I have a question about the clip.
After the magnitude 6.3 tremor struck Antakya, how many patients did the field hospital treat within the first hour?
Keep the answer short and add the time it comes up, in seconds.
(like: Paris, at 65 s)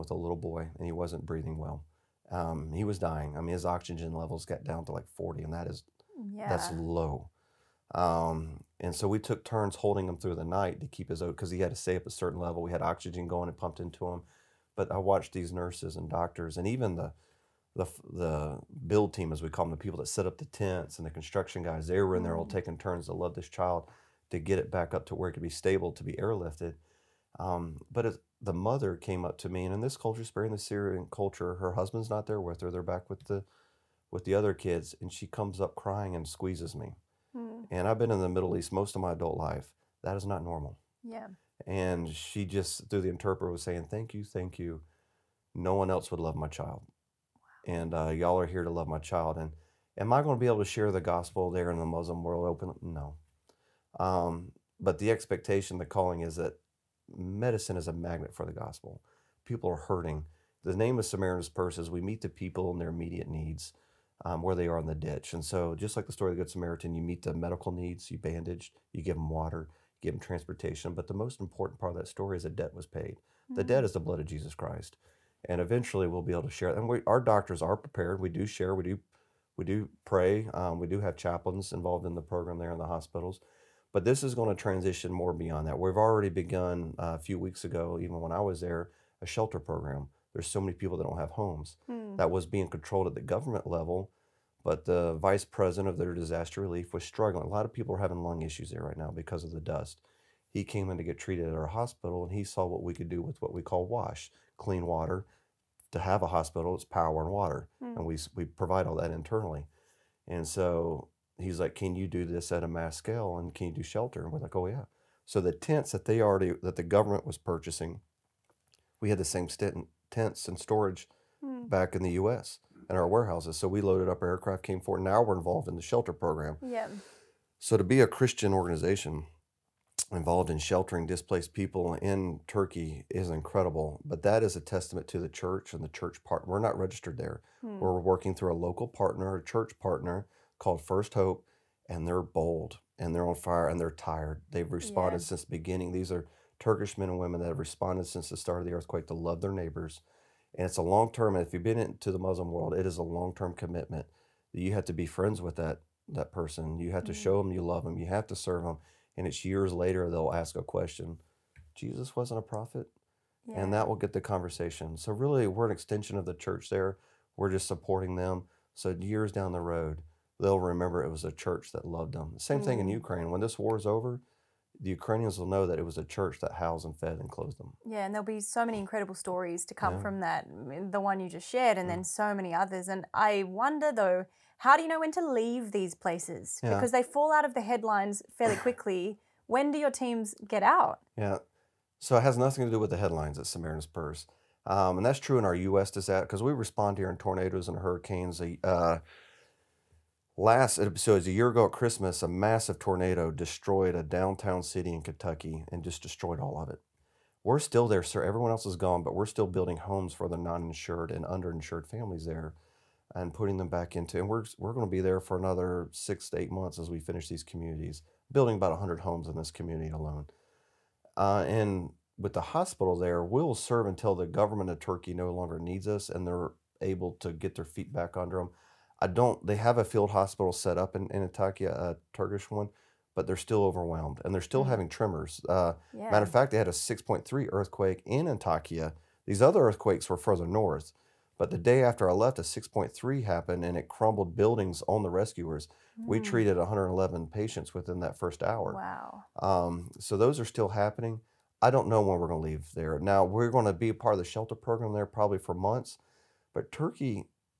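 111, at 246 s.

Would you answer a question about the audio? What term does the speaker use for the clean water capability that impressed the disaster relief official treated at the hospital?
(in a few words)
WASH.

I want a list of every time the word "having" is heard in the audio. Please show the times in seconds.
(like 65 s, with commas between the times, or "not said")
97 s, 234 s.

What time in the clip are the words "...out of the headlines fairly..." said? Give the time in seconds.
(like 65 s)
187 s.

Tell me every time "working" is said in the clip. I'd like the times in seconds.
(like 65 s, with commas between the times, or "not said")
137 s.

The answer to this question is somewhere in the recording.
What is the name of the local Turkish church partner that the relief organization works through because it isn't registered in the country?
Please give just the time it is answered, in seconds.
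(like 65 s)
140 s.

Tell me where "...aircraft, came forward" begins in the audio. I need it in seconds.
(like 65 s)
124 s.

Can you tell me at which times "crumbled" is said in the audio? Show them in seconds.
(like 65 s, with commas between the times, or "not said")
243 s.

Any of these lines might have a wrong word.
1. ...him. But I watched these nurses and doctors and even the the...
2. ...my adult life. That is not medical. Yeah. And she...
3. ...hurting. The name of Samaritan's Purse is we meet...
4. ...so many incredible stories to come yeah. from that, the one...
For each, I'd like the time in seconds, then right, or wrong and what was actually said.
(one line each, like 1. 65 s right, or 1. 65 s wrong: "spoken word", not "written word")
1. 14 s right
2. 39 s wrong: "normal", not "medical"
3. 59 s right
4. 178 s right.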